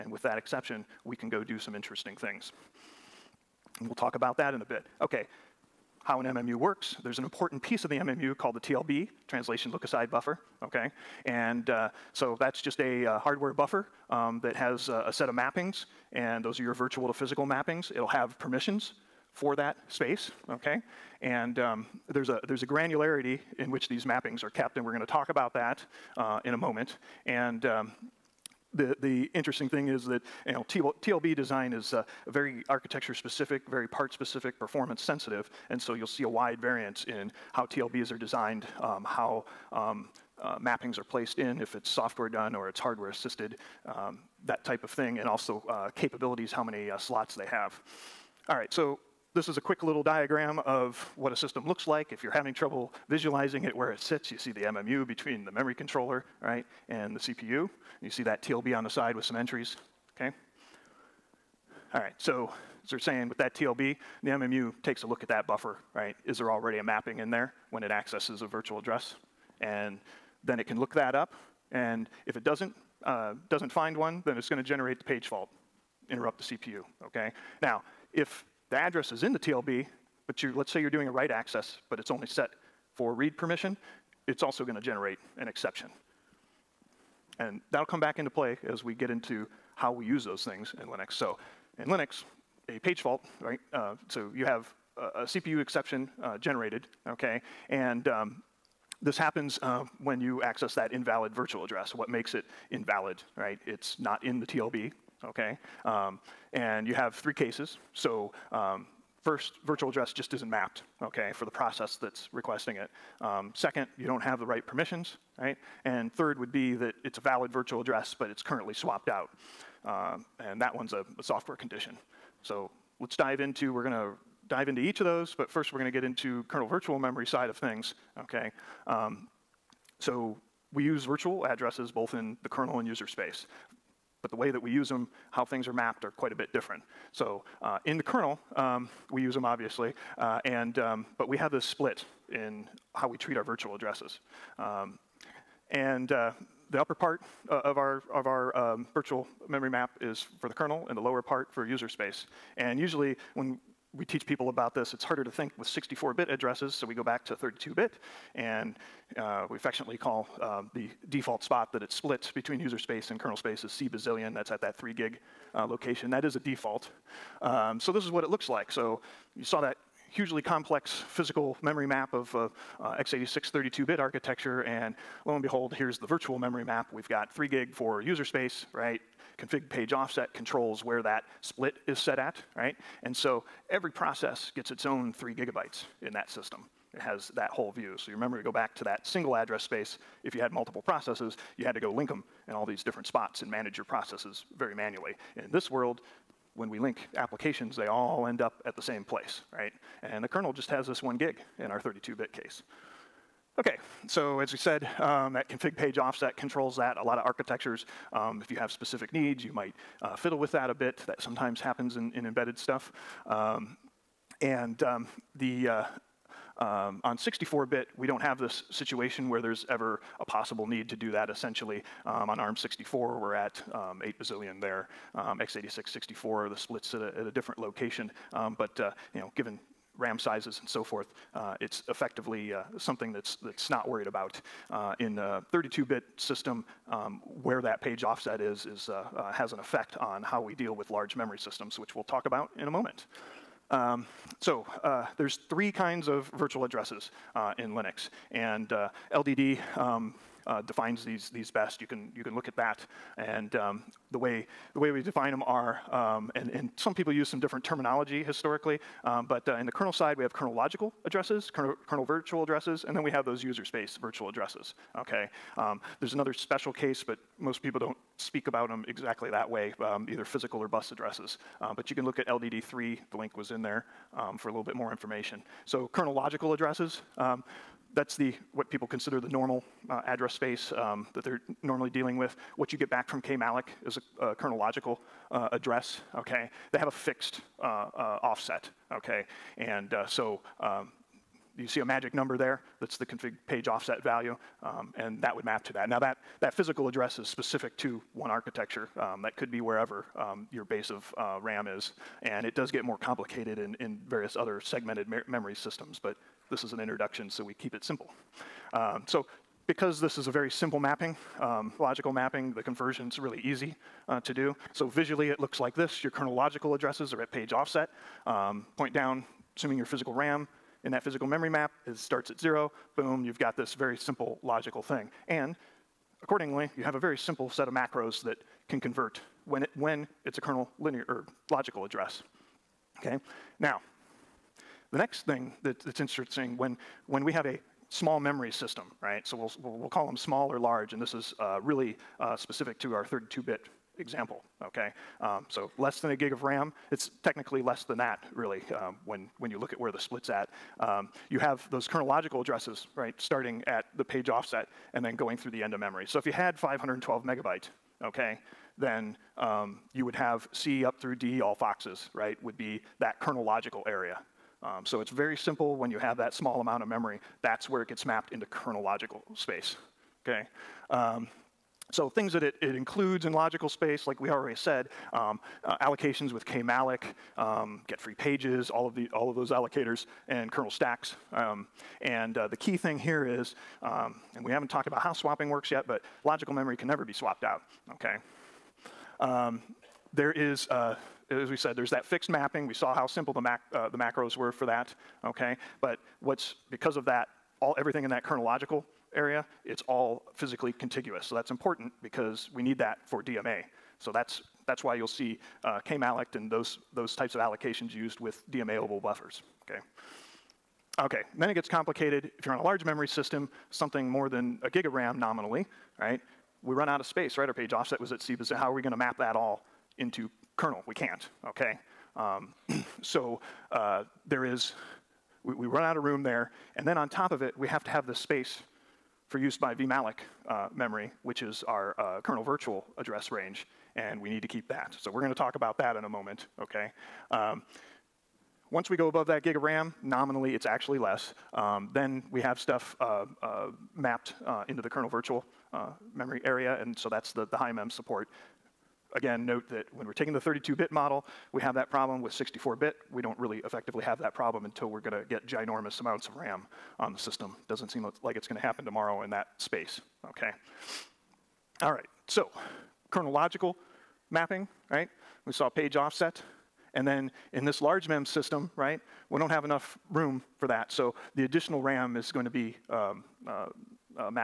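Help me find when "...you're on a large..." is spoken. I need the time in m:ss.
6:52.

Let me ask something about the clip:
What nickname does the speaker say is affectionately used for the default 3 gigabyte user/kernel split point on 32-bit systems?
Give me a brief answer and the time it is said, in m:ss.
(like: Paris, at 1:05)
C bazillion, at 2:43.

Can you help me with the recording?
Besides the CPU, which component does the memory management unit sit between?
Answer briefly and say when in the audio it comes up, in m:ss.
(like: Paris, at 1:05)
memory controller, at 0:55.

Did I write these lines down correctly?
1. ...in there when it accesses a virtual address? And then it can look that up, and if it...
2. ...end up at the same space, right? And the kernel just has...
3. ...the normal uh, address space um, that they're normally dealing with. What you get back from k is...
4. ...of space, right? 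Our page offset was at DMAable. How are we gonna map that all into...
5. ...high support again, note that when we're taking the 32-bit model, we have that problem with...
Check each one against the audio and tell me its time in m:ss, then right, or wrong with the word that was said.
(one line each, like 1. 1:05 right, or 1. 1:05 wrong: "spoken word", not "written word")
1. 1:07 right
2. 3:18 wrong: "place", not "space"
3. 4:39 right
4. 6:57 wrong: "CBIS", not "DMAable"
5. 7:27 right.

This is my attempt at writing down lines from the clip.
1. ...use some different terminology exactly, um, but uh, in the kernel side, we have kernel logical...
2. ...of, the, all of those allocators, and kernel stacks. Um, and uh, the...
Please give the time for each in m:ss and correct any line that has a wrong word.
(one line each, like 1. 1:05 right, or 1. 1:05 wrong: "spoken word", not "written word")
1. 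4:17 wrong: "historically", not "exactly"
2. 6:18 right.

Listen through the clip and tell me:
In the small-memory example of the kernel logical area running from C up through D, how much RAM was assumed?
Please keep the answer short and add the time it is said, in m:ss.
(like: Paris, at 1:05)
512 megabytes, at 5:56.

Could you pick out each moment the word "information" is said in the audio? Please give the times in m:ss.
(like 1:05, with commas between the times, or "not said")
4:34.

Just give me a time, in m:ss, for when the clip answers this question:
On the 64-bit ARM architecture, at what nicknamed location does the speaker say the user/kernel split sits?
3:44.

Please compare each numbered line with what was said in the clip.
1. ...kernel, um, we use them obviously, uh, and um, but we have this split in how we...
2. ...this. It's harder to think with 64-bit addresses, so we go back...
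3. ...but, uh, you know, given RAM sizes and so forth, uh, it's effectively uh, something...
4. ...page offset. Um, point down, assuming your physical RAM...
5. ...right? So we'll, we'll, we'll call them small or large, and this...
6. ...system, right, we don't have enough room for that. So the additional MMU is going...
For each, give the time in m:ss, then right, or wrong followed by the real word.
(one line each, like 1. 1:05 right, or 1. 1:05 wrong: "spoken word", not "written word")
1. 2:18 right
2. 2:34 right
3. 3:48 right
4. 5:17 right
5. 5:39 right
6. 7:48 wrong: "RAM", not "MMU".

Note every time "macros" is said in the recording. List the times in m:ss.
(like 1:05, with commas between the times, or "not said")
5:27, 6:33.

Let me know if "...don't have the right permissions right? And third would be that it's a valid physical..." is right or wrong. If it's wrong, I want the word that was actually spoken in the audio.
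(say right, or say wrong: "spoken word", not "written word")
wrong: "virtual", not "physical".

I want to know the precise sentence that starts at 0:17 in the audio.
It'll have permissions for that space, okay?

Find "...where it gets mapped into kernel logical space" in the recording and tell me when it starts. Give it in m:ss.
6:07.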